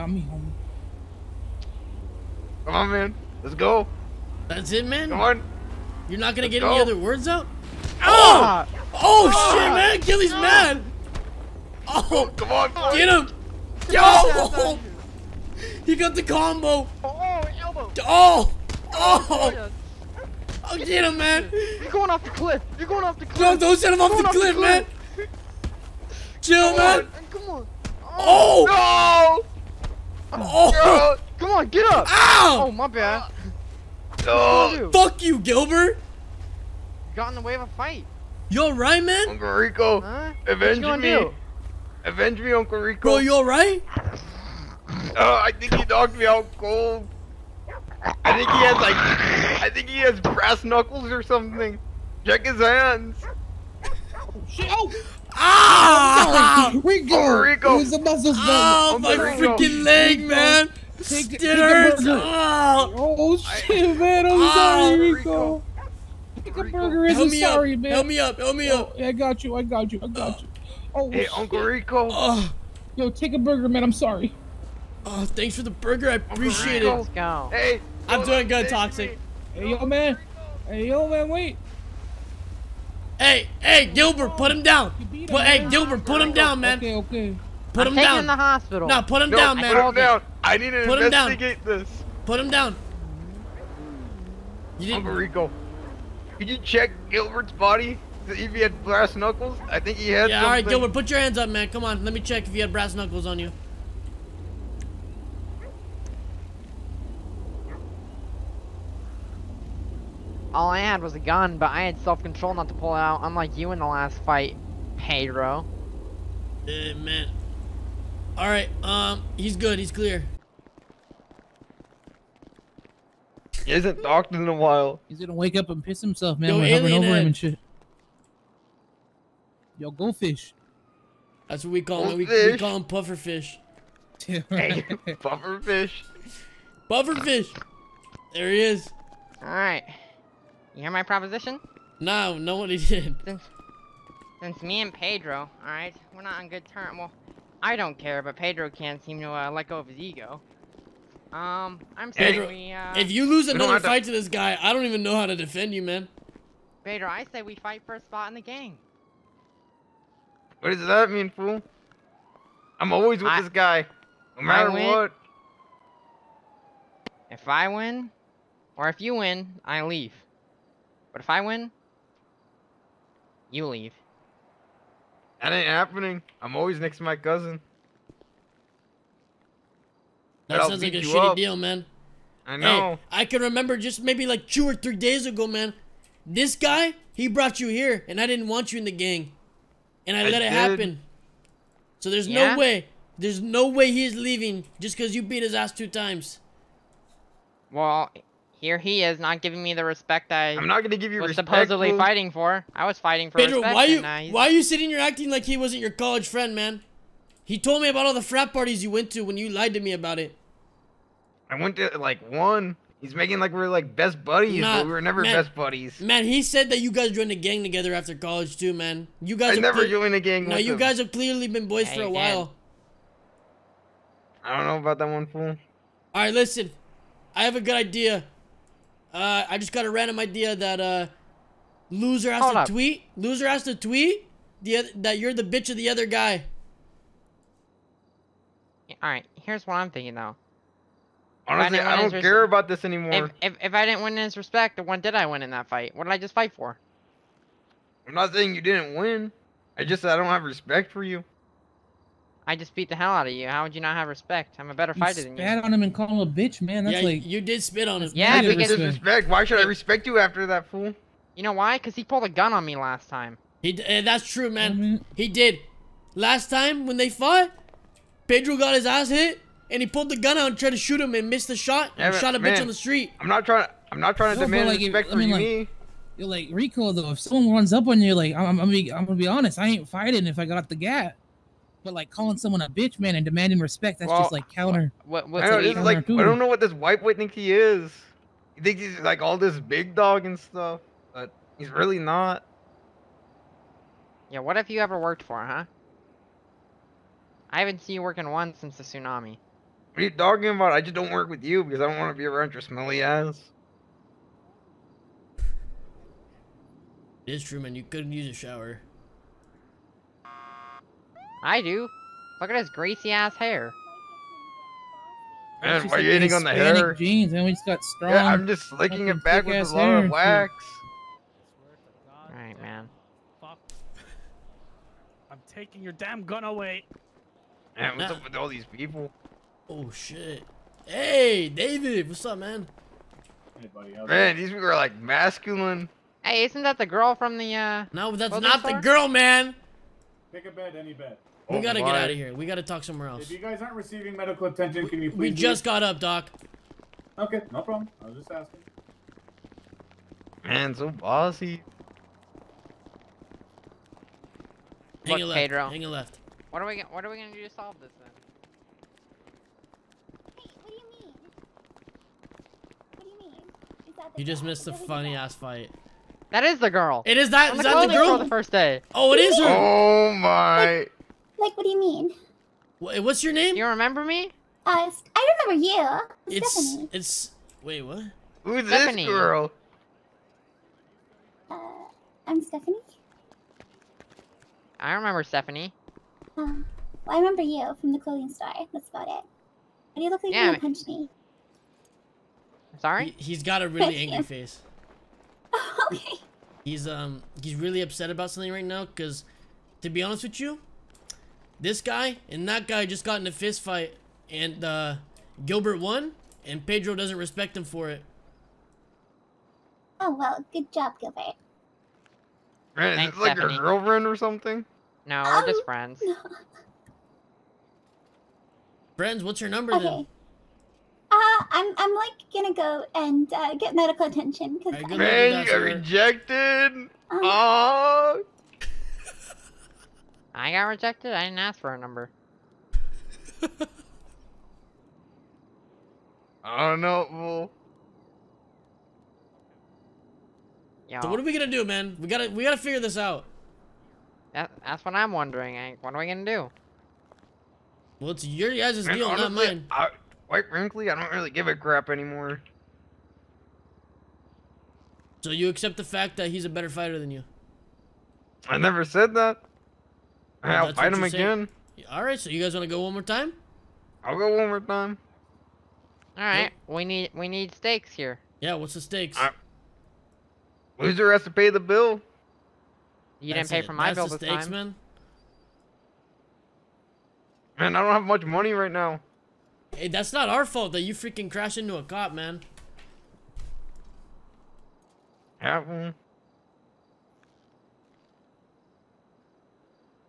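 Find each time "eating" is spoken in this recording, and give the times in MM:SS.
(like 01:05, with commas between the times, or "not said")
05:16.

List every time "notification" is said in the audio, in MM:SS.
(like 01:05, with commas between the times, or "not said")
not said.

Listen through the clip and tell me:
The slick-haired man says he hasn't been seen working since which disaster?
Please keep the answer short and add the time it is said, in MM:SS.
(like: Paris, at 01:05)
the tsunami, at 04:58.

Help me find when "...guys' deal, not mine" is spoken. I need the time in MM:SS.
07:28.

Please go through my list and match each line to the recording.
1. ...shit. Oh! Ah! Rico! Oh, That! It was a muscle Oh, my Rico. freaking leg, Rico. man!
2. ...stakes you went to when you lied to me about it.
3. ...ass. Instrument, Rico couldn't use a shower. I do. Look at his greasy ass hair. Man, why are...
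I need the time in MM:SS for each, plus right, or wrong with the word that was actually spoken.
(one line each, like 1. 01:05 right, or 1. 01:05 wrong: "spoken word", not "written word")
1. 00:54 wrong: "Rico", not "That"
2. 03:28 wrong: "parties", not "stakes"
3. 05:03 wrong: "You", not "Rico".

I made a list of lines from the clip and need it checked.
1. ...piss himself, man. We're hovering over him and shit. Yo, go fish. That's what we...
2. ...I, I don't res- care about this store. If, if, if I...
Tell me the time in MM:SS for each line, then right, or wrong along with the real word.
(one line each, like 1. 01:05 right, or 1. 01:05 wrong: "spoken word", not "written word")
1. 02:05 right
2. 04:01 wrong: "anymore", not "store".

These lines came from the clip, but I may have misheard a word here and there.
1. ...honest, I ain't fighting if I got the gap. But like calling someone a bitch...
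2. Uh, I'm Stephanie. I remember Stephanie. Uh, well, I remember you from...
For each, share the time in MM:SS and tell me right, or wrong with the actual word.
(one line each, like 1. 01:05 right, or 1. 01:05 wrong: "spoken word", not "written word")
1. 04:39 right
2. 06:21 right.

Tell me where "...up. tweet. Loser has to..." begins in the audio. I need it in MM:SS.
03:52.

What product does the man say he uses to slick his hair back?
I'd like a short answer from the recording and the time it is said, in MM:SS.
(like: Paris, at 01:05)
wax, at 05:20.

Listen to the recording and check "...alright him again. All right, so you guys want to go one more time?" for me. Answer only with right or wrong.
wrong.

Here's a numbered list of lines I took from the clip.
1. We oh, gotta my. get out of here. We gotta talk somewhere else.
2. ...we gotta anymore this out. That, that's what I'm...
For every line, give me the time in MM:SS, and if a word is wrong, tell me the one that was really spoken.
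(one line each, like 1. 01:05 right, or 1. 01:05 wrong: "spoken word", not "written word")
1. 05:41 right
2. 07:22 wrong: "figure", not "anymore".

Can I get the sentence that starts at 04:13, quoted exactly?
How would you not have respect?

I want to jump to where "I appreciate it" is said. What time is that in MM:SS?
01:16.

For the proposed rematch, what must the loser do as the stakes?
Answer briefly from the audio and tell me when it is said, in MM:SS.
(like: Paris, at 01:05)
pay the bill, at 07:51.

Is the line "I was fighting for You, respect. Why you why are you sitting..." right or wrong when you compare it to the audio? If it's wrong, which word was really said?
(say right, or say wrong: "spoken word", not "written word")
wrong: "Pedro", not "You".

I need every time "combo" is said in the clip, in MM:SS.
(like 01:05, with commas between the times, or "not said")
00:16.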